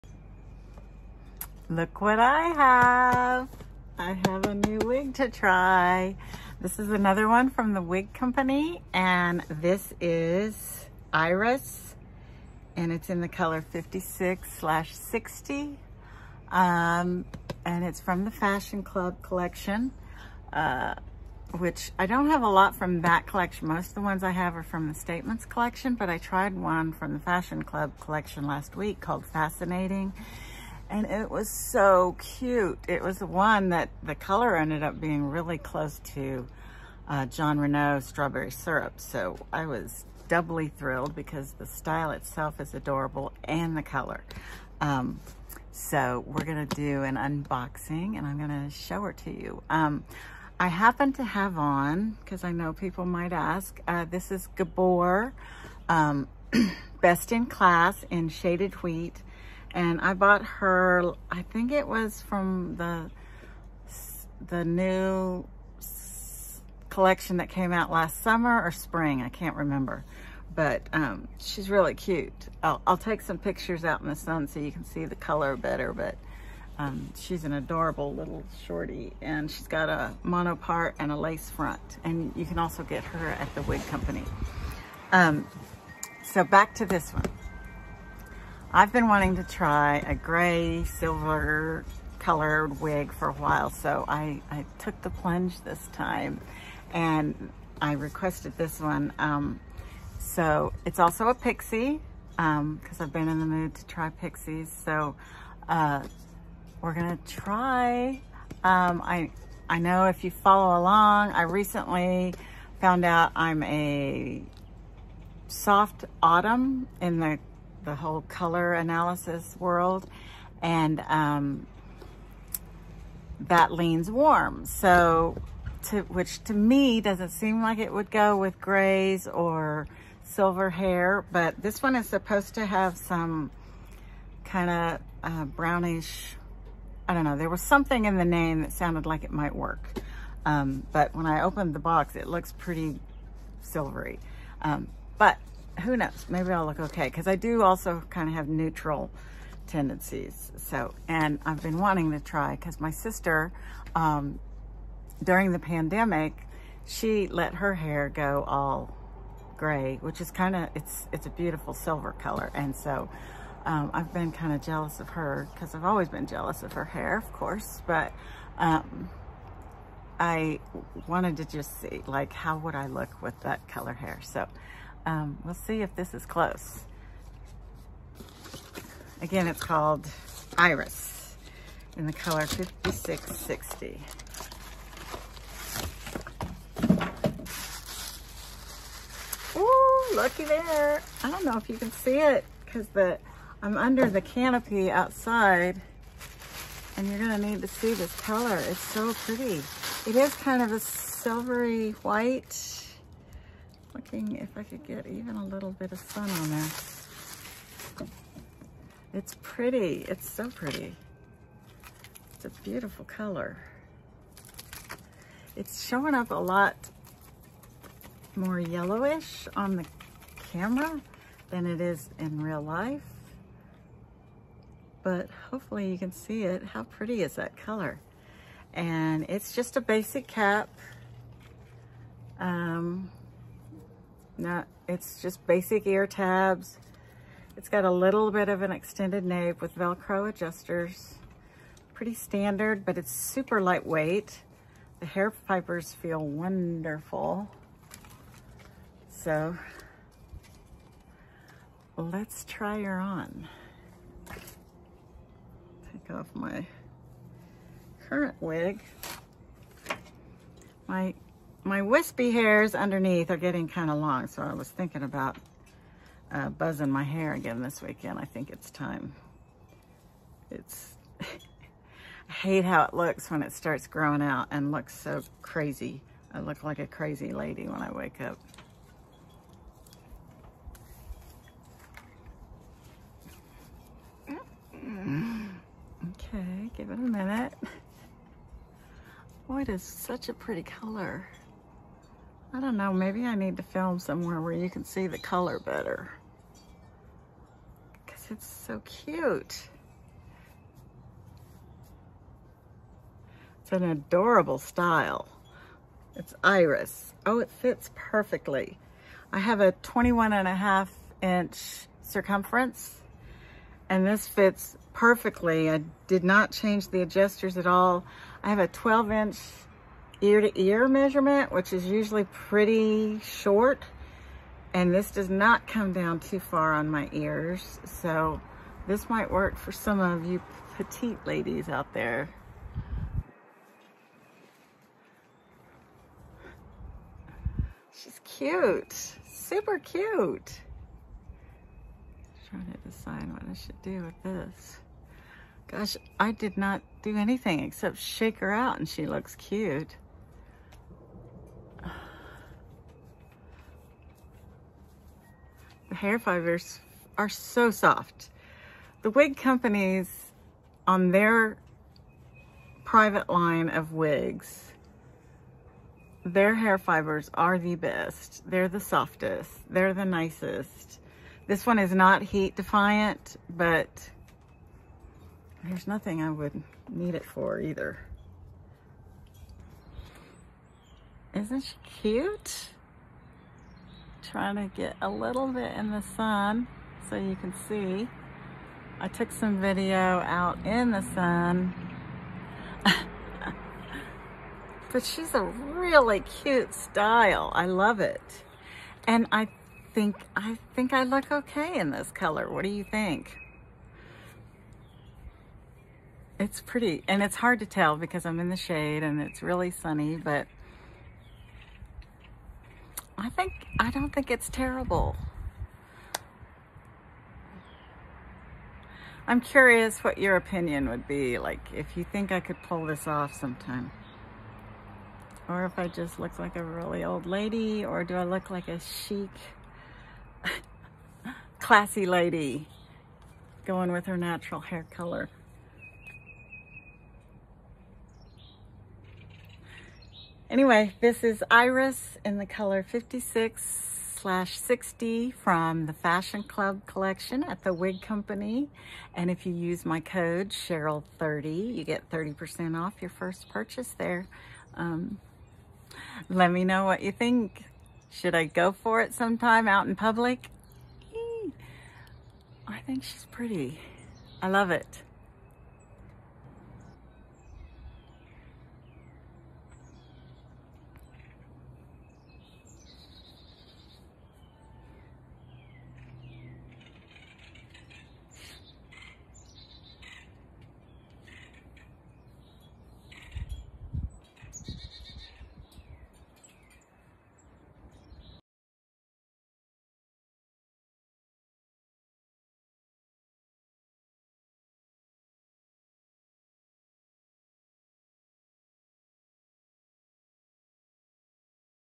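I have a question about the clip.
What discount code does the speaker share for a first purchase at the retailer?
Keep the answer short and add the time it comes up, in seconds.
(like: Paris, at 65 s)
Cheryl30, at 450 s.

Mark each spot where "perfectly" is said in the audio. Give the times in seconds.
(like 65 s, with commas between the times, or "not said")
307 s, 314 s.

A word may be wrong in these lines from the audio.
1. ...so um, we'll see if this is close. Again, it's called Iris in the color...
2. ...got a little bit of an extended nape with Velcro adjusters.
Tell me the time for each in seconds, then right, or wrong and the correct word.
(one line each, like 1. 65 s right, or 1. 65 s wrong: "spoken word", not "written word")
1. 174 s right
2. 237 s right.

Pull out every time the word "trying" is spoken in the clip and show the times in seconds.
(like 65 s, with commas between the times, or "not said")
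342 s, 384 s.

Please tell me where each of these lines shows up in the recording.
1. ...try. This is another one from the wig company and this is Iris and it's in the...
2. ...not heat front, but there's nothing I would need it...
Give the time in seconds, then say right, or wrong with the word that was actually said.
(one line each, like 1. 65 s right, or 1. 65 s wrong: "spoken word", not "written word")
1. 5 s right
2. 371 s wrong: "defiant", not "front".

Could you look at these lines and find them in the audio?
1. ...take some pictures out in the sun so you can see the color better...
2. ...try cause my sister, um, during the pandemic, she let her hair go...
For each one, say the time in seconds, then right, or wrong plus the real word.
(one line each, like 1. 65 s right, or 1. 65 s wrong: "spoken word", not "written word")
1. 72 s right
2. 152 s right.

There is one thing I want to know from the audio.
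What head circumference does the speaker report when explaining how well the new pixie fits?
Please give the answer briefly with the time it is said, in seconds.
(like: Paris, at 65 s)
21 and a half inches, at 309 s.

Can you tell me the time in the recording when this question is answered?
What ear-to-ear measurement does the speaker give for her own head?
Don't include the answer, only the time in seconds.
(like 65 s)
318 s.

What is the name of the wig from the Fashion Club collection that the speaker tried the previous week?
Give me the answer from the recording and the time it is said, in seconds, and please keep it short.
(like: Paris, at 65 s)
Fascinating, at 29 s.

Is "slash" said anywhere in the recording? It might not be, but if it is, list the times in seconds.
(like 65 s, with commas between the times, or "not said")
14 s, 444 s.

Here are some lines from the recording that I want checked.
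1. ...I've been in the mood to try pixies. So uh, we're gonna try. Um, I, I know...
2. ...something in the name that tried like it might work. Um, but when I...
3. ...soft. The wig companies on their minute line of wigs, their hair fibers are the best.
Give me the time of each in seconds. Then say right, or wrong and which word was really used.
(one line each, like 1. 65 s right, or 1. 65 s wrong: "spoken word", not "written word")
1. 102 s right
2. 137 s wrong: "sounded", not "tried"
3. 357 s wrong: "private", not "minute".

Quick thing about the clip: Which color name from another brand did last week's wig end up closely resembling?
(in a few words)
strawberry syrup.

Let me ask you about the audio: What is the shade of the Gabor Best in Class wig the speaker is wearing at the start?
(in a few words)
shaded wheat.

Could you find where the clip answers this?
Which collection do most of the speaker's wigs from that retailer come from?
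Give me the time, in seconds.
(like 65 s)
24 s.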